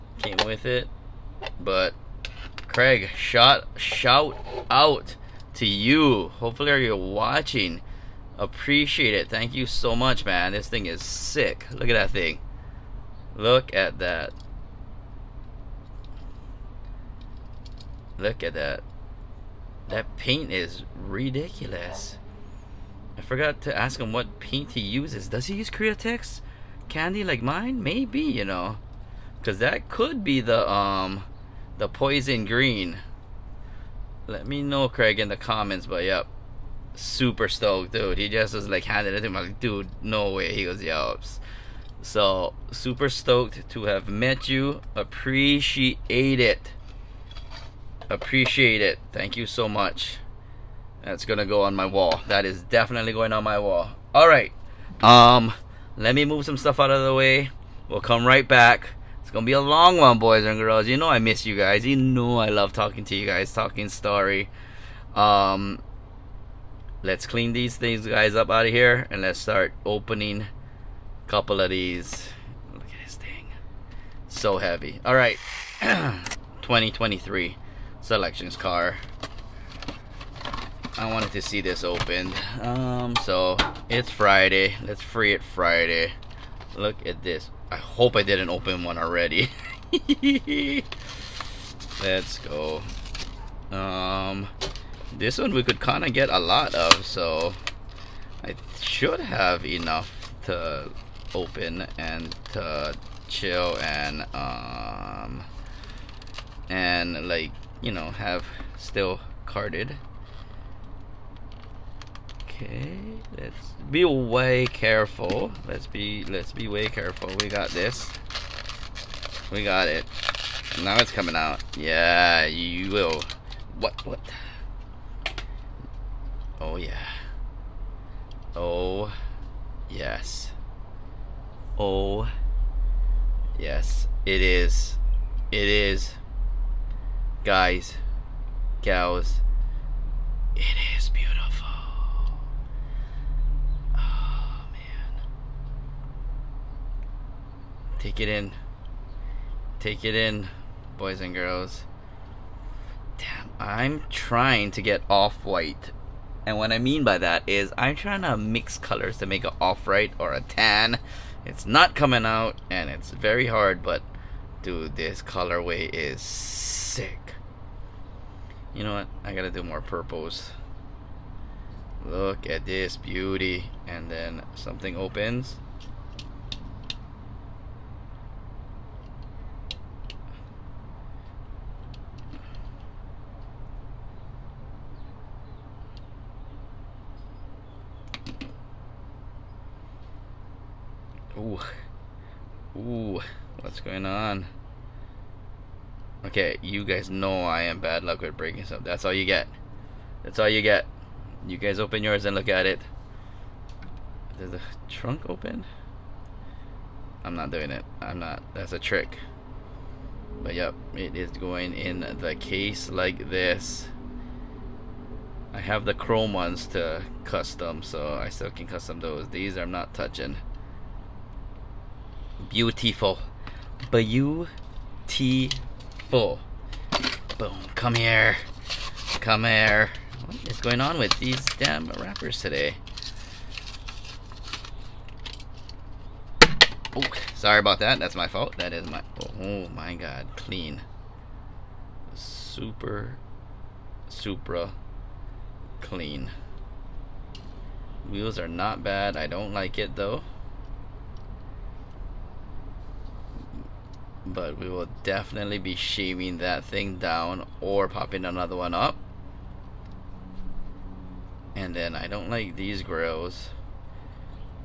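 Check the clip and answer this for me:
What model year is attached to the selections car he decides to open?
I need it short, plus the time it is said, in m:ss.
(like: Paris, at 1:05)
2023, at 1:15.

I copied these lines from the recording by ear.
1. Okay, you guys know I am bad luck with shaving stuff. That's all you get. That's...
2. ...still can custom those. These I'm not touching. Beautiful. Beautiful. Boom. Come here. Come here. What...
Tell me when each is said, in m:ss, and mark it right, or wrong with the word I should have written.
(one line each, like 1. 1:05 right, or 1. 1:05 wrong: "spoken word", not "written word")
1. 3:16 wrong: "breaking", not "shaving"
2. 3:38 right.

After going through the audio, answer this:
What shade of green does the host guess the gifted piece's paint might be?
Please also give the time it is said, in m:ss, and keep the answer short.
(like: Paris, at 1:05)
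poison green, at 0:31.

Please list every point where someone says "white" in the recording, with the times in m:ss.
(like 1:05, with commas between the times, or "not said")
2:35, 2:39.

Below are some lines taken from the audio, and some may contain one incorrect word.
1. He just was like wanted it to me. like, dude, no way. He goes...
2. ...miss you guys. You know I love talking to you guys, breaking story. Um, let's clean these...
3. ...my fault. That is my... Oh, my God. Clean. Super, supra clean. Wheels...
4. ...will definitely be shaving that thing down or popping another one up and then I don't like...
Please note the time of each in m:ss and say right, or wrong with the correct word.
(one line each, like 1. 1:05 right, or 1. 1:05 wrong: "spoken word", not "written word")
1. 0:38 wrong: "handed", not "wanted"
2. 1:01 wrong: "talking", not "breaking"
3. 3:58 right
4. 4:14 right.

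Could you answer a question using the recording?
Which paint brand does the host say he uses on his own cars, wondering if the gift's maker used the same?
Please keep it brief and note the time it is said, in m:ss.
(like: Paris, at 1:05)
Createx, at 0:25.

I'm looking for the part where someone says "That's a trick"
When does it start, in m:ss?
3:28.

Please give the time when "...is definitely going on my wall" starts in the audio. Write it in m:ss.
0:52.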